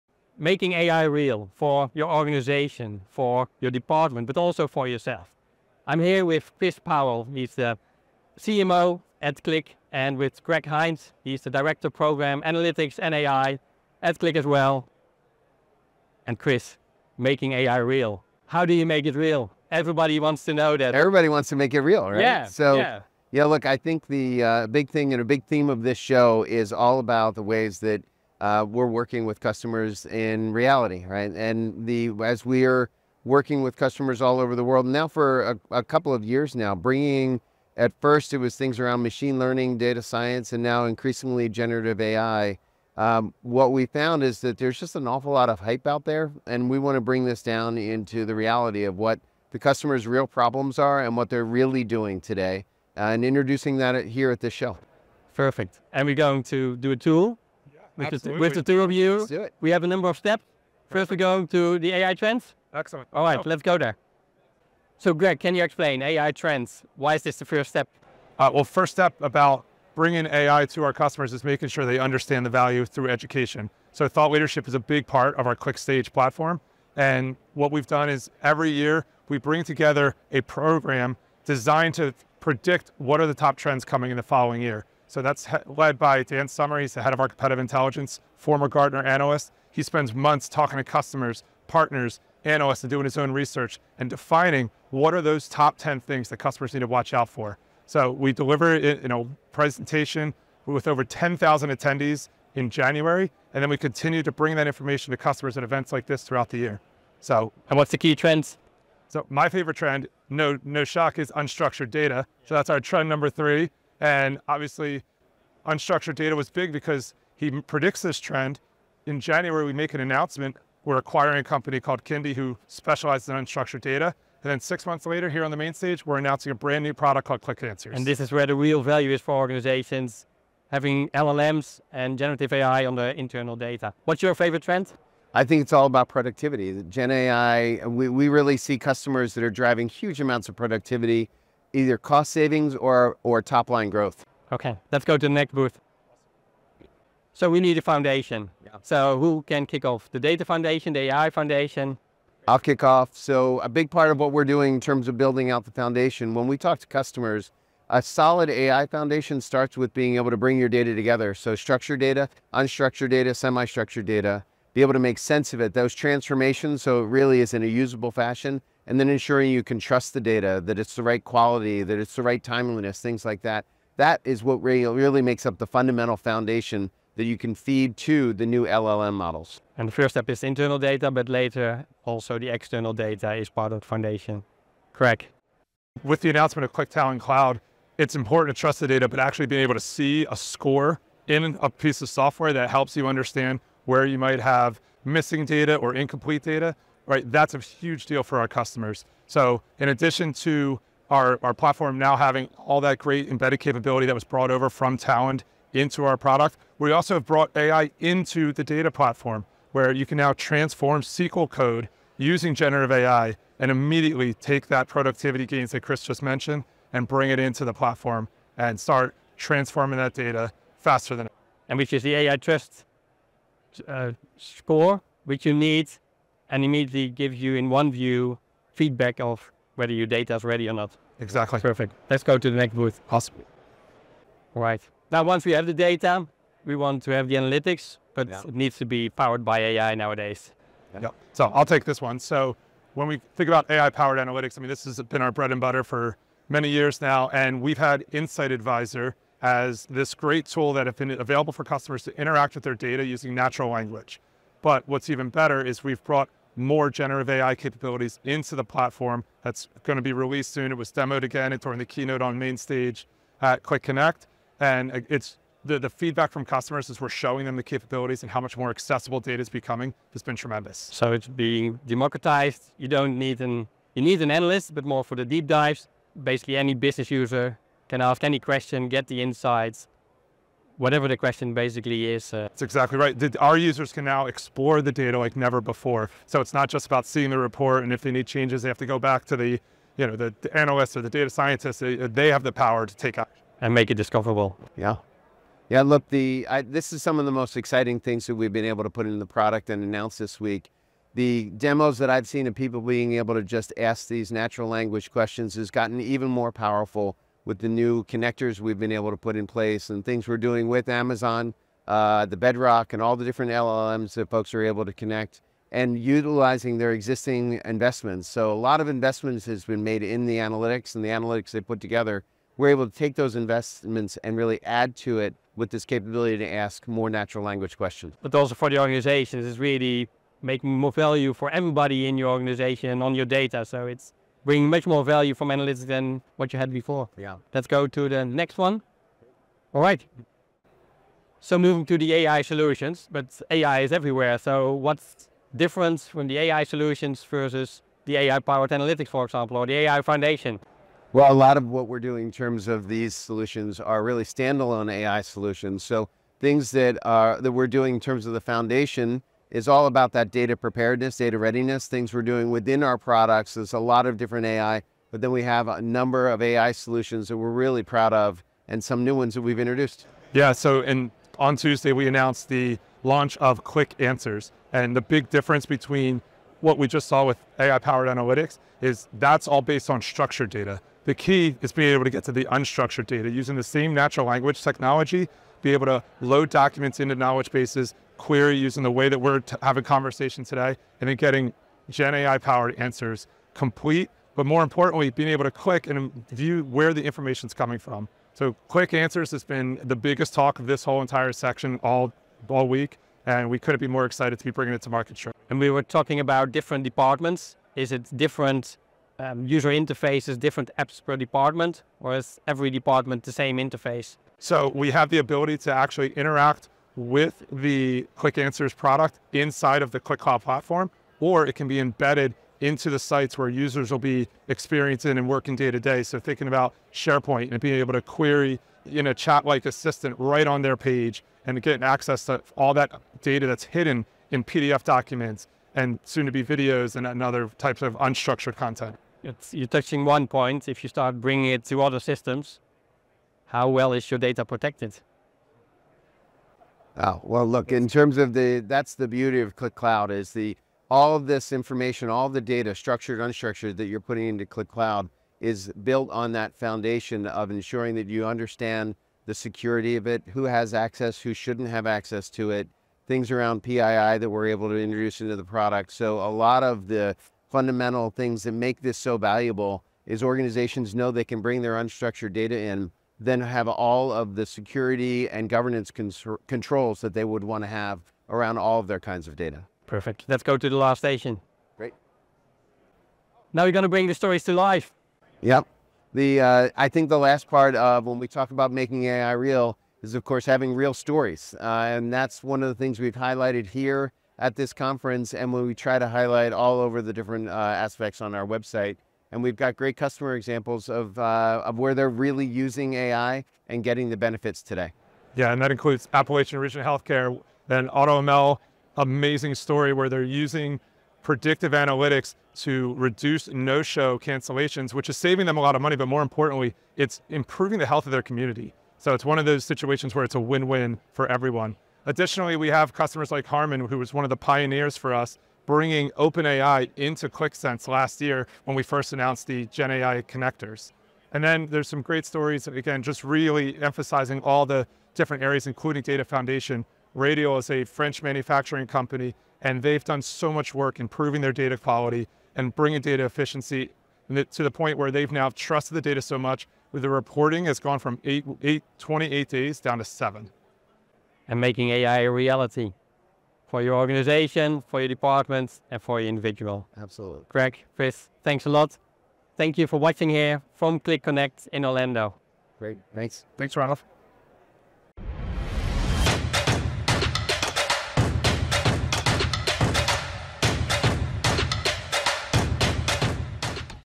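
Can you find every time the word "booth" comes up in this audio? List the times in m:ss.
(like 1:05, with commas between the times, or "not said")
2:25, 3:52.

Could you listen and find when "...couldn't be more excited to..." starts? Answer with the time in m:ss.
6:43.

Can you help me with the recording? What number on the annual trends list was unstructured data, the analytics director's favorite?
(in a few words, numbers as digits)
3.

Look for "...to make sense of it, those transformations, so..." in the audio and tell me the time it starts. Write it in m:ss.
2:44.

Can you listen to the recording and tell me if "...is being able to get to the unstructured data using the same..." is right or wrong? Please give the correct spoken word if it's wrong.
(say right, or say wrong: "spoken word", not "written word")
right.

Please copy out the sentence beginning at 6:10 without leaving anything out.
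Yeah, so and on Tuesday we announced the launch of Qlik Answers.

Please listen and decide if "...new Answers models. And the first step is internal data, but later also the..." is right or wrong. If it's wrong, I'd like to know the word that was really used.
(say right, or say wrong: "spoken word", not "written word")
wrong: "LLM", not "Answers".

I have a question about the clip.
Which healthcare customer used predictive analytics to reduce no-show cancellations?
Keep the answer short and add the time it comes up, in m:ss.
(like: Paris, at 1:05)
Appalachian Region Healthcare, at 8:26.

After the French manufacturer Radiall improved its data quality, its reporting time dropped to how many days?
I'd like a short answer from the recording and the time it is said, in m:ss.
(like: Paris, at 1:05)
7, at 9:10.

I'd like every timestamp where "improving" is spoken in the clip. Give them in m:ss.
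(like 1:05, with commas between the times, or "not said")
8:37, 9:00.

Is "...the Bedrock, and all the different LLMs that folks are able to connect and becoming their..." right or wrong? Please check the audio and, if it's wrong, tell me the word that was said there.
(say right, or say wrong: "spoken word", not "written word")
wrong: "utilizing", not "becoming".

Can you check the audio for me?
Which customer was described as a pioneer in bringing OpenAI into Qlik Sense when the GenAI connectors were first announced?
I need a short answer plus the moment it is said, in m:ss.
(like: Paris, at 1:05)
Harman, at 8:43.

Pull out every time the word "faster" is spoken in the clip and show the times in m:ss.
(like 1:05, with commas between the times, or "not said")
3:40.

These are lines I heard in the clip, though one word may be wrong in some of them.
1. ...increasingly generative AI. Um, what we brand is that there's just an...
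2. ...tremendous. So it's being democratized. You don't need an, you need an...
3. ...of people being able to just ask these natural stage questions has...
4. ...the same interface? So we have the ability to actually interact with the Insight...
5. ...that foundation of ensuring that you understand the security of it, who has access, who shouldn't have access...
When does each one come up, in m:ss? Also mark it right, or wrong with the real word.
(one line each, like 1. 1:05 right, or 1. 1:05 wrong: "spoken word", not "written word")
1. 0:40 wrong: "found", not "brand"
2. 4:30 right
3. 5:02 wrong: "language", not "stage"
4. 6:53 wrong: "Qlik", not "Insight"
5. 7:36 right.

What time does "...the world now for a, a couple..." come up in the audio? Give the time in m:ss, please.
0:34.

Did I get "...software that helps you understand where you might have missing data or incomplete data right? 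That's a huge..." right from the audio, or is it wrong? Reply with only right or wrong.
right.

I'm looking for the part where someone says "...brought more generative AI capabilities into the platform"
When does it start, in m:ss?
4:16.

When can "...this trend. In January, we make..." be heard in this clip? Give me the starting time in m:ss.
1:58.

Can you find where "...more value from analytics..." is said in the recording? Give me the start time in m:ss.
5:34.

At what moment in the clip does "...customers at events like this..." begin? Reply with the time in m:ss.
1:45.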